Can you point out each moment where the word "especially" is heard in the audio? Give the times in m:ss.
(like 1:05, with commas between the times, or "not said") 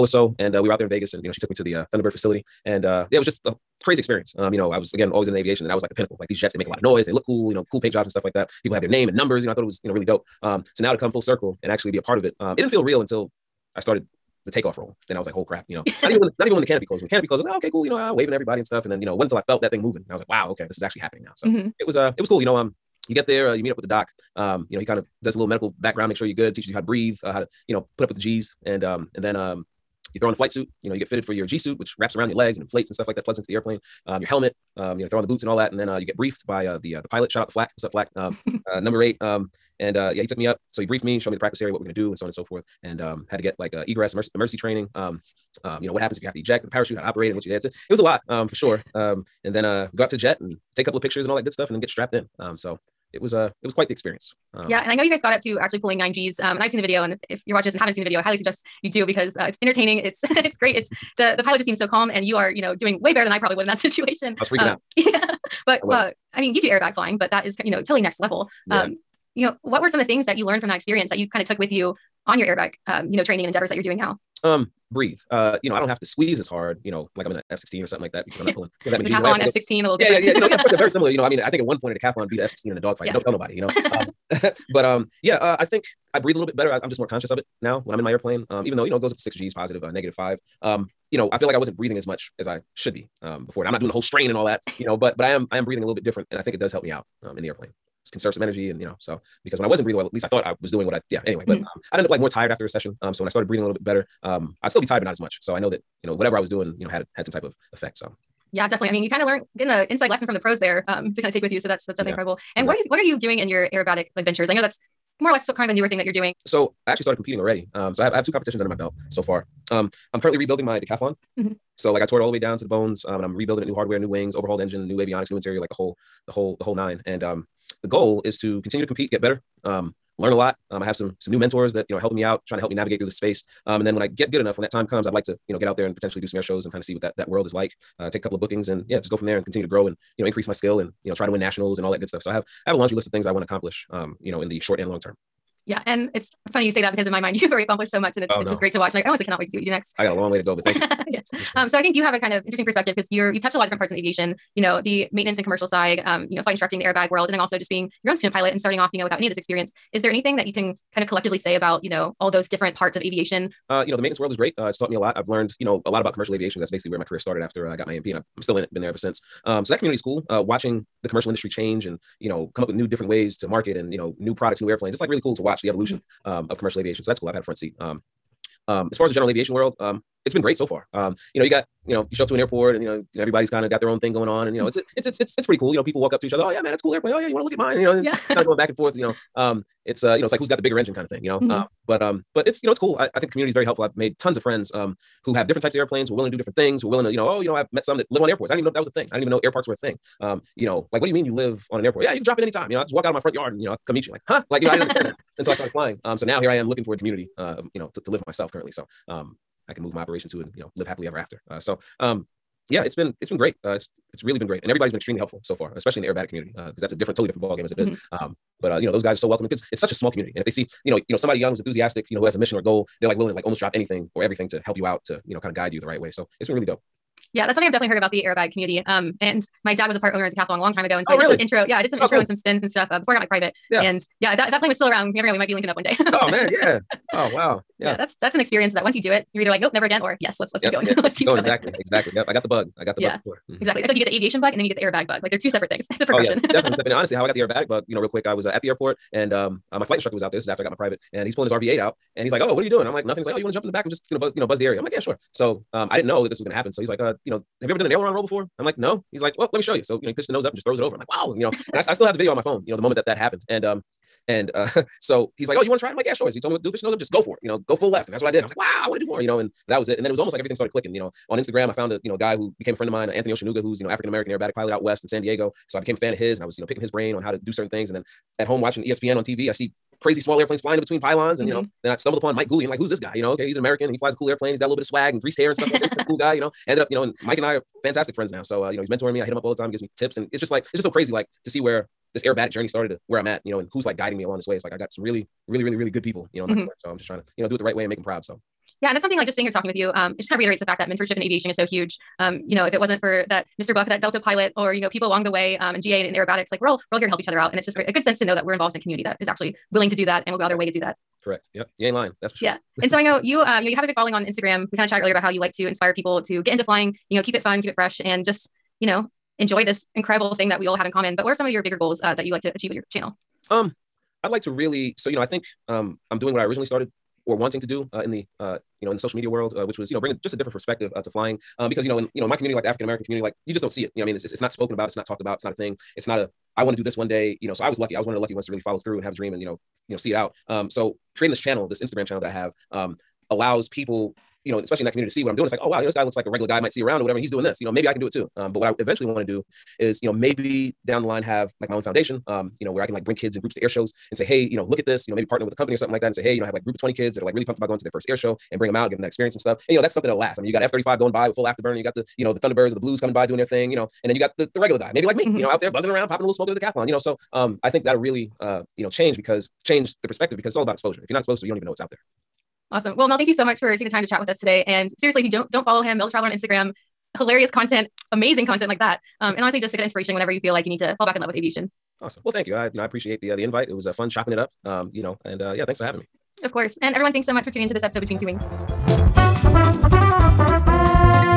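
3:35, 5:44.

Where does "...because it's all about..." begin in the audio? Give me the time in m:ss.
6:10.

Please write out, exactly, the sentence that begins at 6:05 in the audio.
you know, out there buzzing around, popping a little smoke into the decathlon, you know.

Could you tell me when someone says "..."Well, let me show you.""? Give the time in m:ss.
4:19.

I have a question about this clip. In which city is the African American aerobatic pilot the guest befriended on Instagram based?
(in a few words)
San Diego.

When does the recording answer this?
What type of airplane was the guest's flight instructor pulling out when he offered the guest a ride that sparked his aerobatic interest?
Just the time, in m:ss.
4:11.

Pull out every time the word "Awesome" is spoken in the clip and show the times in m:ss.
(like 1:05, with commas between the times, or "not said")
6:12, 6:22.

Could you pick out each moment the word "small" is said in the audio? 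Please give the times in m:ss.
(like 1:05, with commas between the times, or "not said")
3:39, 4:40.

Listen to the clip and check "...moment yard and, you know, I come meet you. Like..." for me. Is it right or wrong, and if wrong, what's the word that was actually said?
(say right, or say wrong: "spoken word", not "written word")
wrong: "front", not "moment".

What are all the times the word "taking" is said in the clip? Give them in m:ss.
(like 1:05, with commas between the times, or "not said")
6:13.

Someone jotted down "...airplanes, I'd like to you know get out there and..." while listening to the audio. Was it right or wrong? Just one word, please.
wrong.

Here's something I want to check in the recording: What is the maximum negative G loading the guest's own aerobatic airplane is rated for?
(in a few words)
5.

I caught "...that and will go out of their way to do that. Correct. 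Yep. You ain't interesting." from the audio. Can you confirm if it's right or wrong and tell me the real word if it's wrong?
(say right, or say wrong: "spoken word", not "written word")
wrong: "lying", not "interesting".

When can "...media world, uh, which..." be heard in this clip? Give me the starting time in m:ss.
5:29.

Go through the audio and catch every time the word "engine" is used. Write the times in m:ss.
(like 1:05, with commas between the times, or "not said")
2:04, 3:10.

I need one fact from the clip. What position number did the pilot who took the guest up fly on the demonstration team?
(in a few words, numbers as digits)
8.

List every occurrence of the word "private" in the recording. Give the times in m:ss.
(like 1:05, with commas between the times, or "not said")
3:53, 4:10.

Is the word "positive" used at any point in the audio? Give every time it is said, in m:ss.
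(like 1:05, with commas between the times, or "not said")
1:29.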